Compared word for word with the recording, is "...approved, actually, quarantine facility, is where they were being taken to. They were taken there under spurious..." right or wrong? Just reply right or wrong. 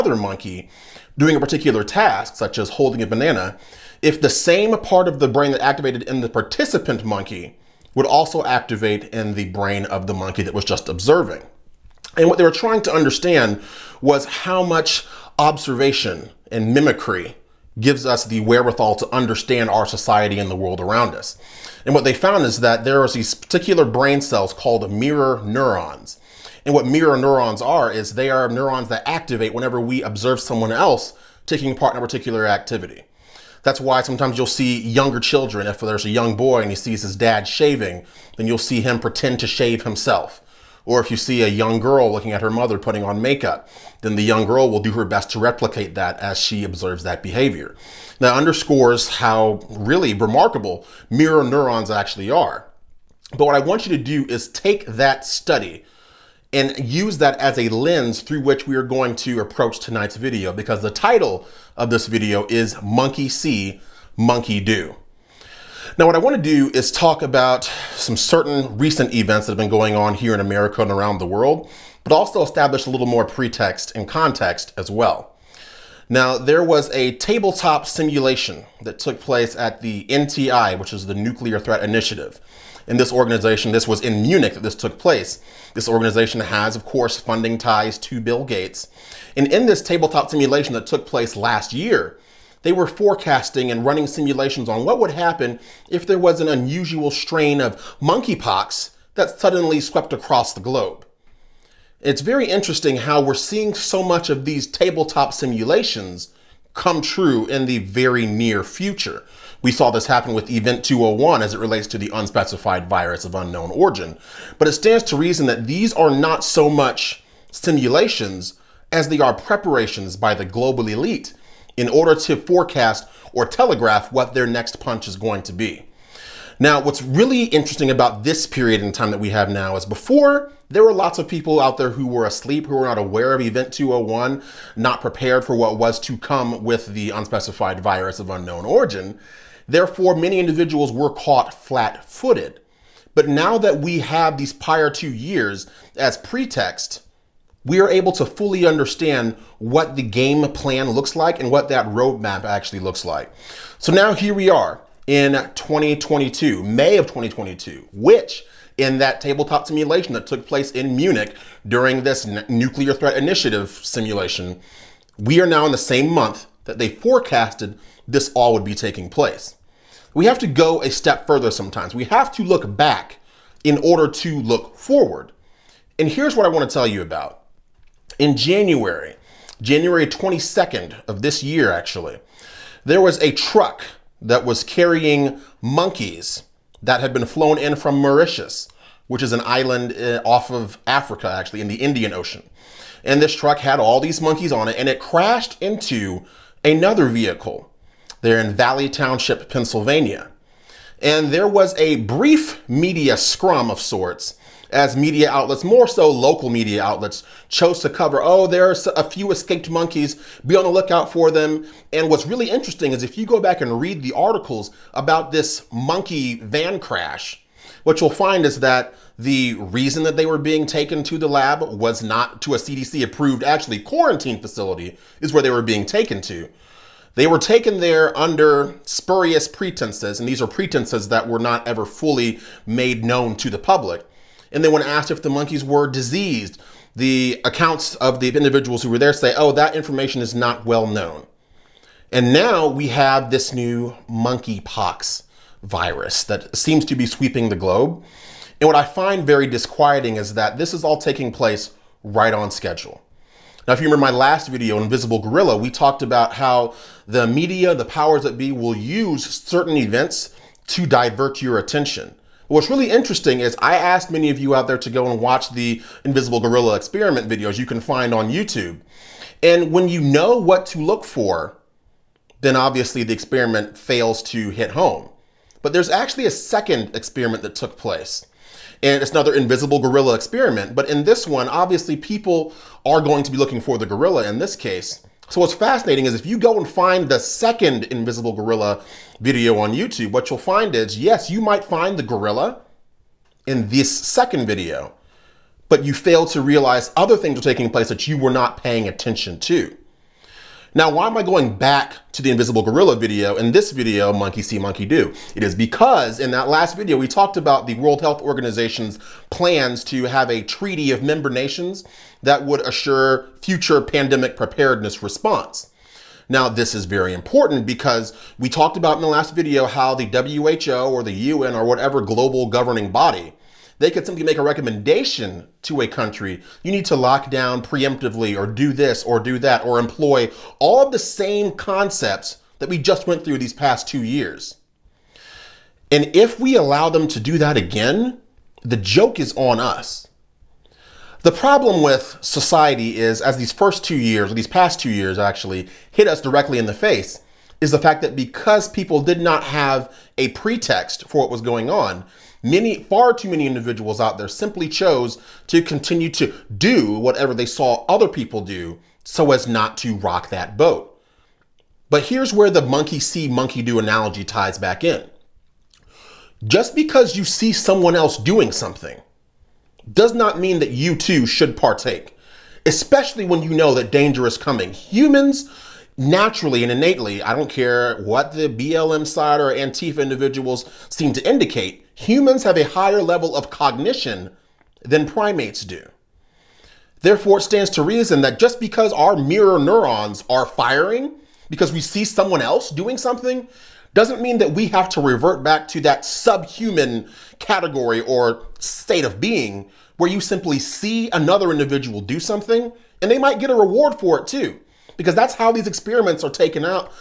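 right.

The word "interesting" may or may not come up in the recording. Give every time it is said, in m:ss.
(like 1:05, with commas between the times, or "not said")
1:42, 2:07, 3:32, 4:22.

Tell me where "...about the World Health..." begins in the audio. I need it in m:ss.
5:07.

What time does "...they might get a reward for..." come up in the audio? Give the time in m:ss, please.
6:43.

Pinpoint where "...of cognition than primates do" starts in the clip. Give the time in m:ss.
6:23.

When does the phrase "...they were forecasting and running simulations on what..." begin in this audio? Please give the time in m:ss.
1:32.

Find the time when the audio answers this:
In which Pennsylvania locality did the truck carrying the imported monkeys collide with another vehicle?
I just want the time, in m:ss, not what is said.
3:18.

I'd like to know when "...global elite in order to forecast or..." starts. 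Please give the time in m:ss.
2:00.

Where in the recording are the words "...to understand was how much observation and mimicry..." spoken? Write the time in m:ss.
0:12.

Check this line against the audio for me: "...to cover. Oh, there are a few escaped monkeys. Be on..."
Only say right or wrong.
right.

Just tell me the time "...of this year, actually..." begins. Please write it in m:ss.
3:01.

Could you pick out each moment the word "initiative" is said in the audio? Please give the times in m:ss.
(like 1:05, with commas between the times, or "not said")
1:21, 2:43.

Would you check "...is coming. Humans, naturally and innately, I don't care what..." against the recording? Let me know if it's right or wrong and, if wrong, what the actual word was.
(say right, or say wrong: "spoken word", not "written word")
right.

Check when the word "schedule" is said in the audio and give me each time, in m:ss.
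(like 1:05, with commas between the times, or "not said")
4:12.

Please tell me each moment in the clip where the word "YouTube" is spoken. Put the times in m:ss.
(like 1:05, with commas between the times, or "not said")
4:28, 4:49.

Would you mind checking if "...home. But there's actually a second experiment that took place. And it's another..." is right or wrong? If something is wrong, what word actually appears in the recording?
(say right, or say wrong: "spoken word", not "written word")
right.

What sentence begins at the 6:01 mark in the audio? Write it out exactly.
But here's where the monkey see, monkey do analogy ties back in.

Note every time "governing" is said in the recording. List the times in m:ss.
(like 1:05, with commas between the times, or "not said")
5:22.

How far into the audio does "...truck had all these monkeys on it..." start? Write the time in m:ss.
3:13.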